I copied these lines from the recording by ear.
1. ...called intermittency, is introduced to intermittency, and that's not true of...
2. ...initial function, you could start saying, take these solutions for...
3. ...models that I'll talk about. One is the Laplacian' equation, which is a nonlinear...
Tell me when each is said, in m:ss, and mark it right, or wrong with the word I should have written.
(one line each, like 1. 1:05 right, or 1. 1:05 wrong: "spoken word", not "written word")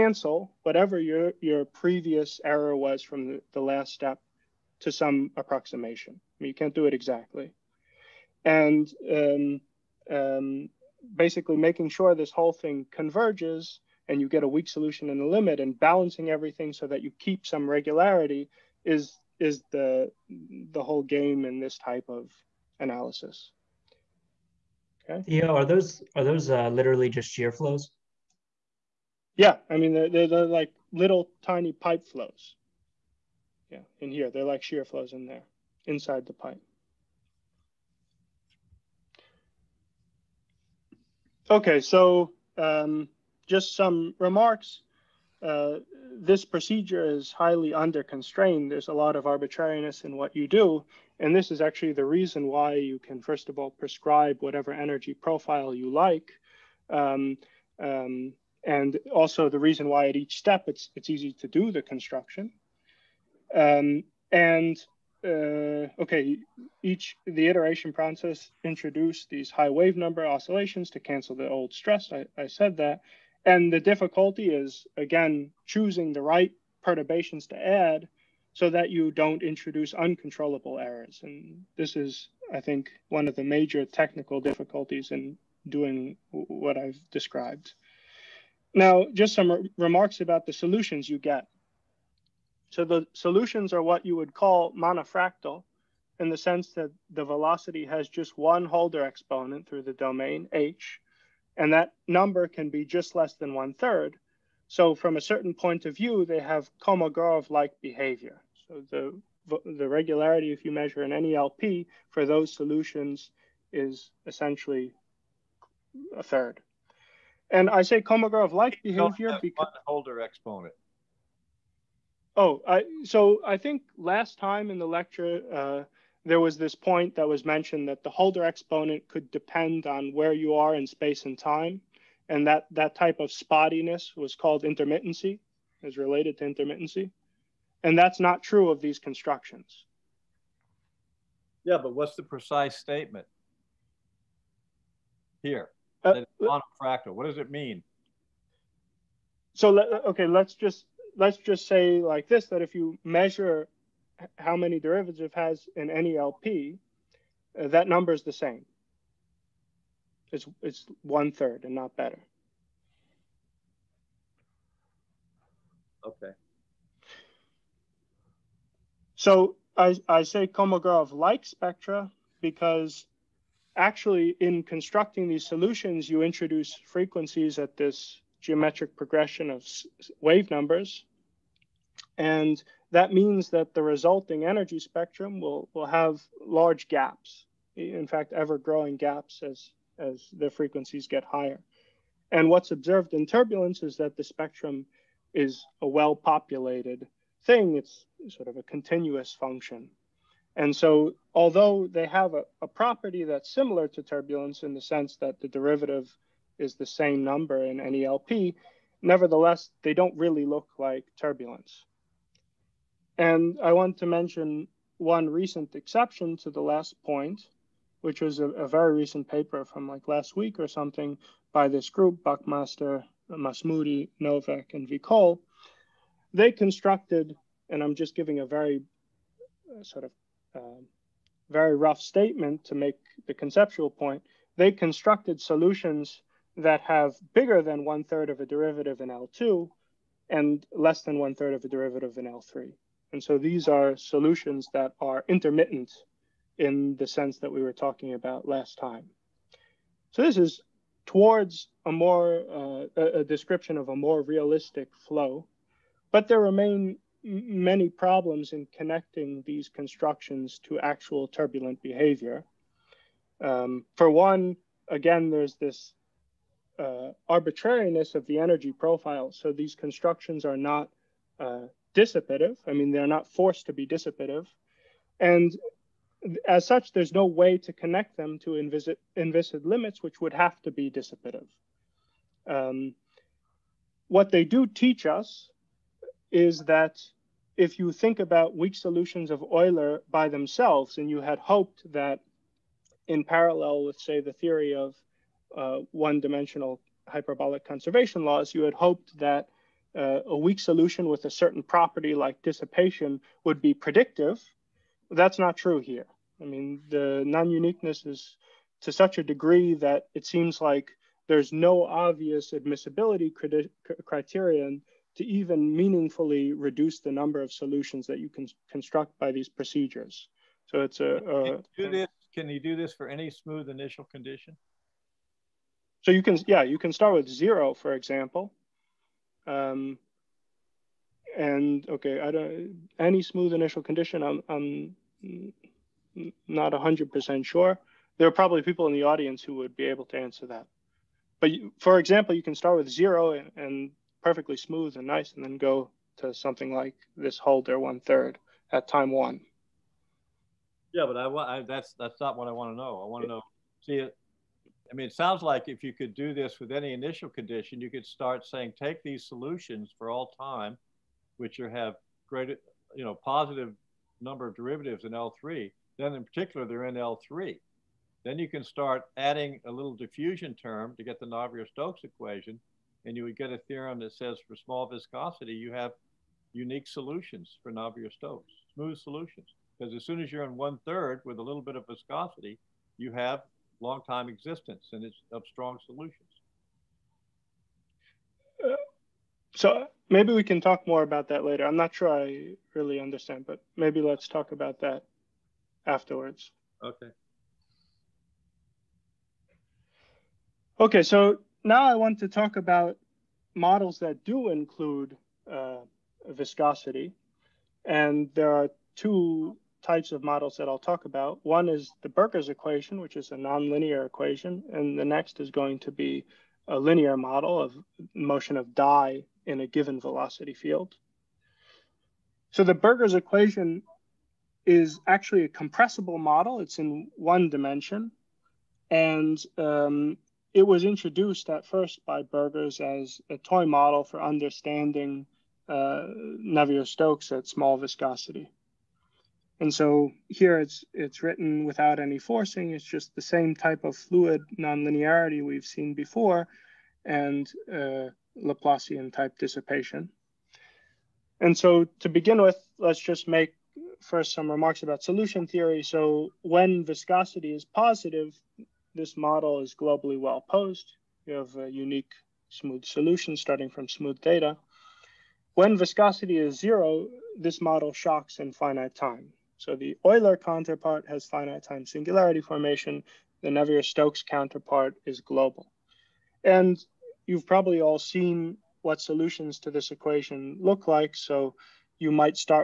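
1. 2:14 wrong: "related", not "introduced"
2. 5:56 wrong: "condition", not "function"
3. 6:50 wrong: "Burgers", not "Laplacian".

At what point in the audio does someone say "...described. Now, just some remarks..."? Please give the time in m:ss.
1:27.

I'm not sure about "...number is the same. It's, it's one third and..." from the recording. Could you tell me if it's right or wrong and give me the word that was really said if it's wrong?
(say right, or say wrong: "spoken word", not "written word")
right.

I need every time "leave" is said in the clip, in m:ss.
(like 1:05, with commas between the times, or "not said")
not said.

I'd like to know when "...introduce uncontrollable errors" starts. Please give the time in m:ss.
1:19.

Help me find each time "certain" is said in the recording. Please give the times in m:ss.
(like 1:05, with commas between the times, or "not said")
1:45, 5:01.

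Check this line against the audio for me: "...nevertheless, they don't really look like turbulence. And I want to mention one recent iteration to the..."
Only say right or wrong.
wrong.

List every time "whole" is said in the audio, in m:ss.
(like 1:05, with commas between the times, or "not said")
0:12, 0:20.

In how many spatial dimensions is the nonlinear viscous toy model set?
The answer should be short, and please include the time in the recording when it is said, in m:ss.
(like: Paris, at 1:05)
1, at 7:07.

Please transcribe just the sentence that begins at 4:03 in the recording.
And so these are solutions that are intermittent in the sense that we were talking about last time.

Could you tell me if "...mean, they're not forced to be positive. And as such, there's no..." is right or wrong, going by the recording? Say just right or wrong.
wrong.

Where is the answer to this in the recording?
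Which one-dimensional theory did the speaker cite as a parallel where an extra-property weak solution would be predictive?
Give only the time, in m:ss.
4:57.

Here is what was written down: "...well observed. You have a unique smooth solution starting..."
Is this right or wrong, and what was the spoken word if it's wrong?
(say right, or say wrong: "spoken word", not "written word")
wrong: "posed", not "observed".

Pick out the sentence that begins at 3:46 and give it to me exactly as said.
They constructed, and I'm just giving a very uh, sort of uh, very rough statement to make the conceptual point.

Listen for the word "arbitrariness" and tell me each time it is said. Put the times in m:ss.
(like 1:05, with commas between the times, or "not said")
0:49, 4:27.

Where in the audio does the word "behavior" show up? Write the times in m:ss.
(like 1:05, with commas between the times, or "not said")
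1:47, 1:58, 4:21.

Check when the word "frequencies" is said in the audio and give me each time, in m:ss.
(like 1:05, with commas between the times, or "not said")
2:56, 3:10.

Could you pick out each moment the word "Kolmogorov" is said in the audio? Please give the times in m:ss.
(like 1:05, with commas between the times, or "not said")
1:46, 1:58, 2:50.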